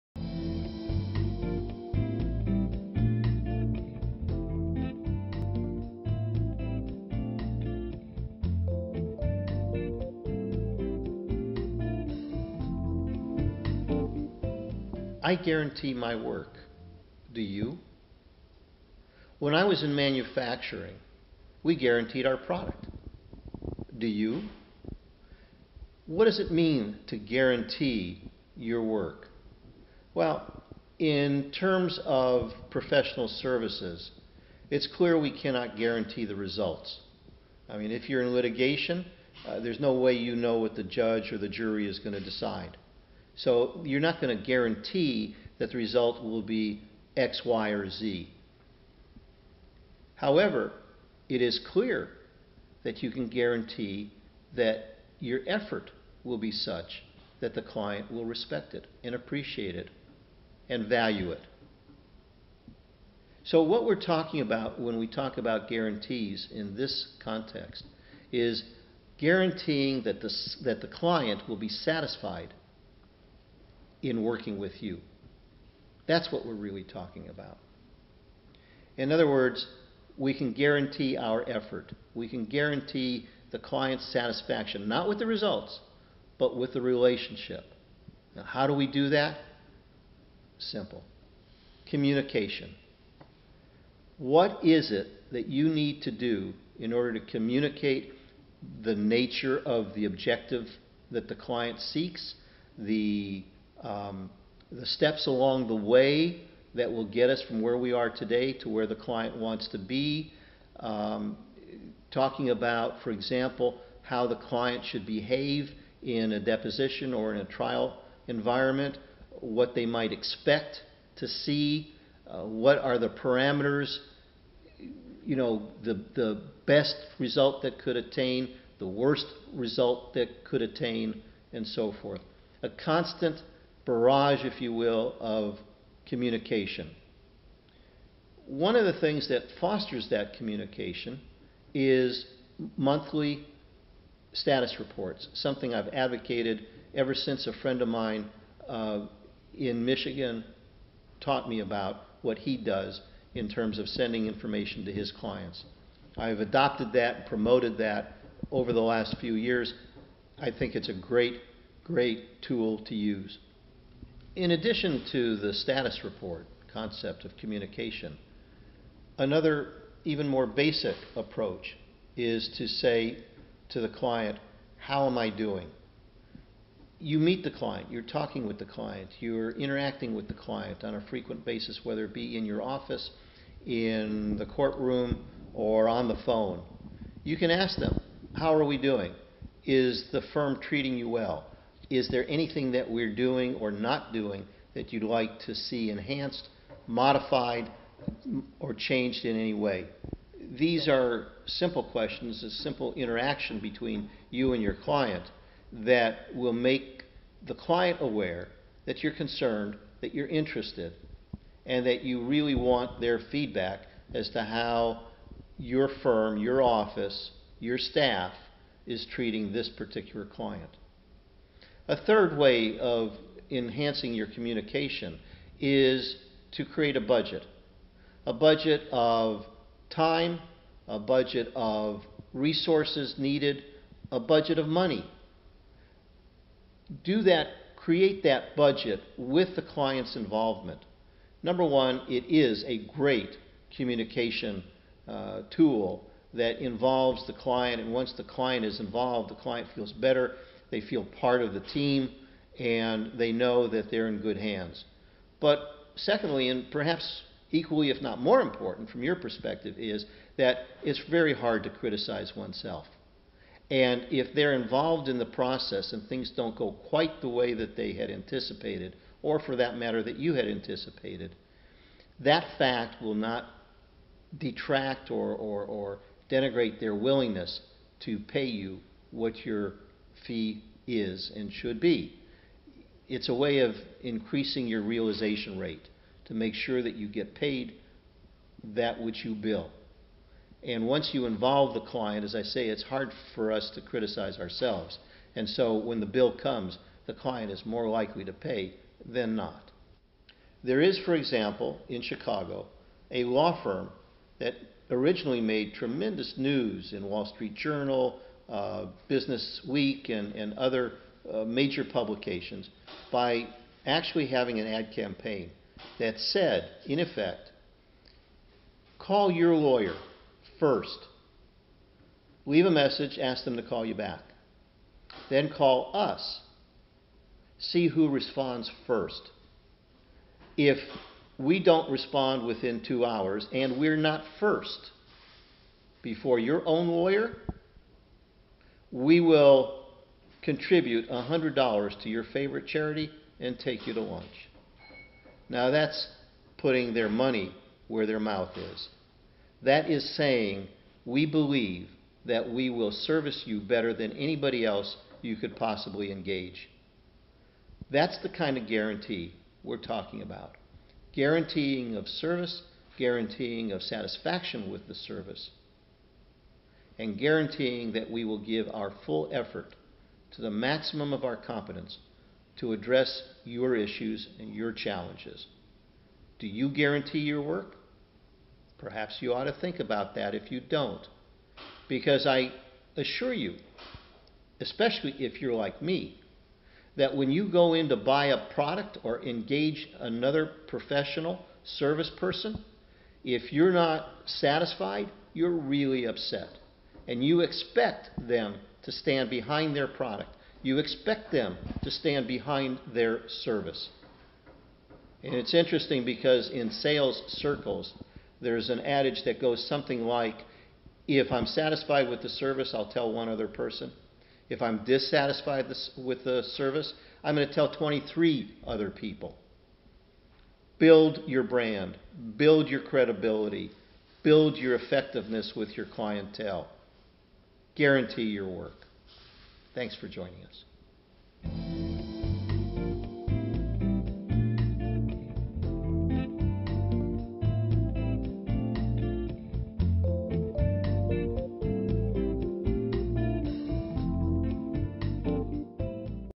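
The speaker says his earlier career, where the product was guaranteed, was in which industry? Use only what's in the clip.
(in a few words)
manufacturing.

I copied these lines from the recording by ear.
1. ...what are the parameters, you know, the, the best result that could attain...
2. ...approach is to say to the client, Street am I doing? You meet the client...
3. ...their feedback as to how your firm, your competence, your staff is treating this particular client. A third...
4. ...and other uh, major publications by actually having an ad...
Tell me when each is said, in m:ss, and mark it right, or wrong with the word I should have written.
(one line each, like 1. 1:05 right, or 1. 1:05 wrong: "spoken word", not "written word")
1. 2:02 right
2. 2:51 wrong: "How", not "Street"
3. 3:33 wrong: "office", not "competence"
4. 5:10 right.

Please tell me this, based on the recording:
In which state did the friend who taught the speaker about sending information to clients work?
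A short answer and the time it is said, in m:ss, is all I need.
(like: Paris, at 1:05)
Michigan, at 2:29.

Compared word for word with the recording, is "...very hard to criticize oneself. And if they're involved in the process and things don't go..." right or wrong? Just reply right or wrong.
right.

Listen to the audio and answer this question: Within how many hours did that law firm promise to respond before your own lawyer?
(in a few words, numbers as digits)
2 hours.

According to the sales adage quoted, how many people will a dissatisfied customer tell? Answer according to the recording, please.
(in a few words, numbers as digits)
23.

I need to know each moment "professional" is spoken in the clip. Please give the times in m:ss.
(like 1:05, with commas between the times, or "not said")
0:32, 6:30.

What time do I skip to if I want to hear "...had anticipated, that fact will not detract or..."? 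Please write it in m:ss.
4:30.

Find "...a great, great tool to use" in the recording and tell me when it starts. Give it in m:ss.
2:40.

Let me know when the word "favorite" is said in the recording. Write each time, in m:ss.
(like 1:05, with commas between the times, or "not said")
5:42.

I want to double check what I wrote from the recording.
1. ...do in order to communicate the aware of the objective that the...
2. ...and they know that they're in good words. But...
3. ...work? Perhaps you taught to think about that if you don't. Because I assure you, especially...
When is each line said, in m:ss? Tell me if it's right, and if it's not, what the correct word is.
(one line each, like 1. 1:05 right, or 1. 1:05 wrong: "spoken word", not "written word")
1. 1:36 wrong: "nature", not "aware"
2. 4:12 wrong: "hands", not "words"
3. 6:17 wrong: "ought", not "taught".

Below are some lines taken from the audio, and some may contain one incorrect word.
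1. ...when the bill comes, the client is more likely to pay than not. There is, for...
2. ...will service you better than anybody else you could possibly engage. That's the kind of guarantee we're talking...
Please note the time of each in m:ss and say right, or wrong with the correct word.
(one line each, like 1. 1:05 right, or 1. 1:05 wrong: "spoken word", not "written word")
1. 4:55 right
2. 5:52 right.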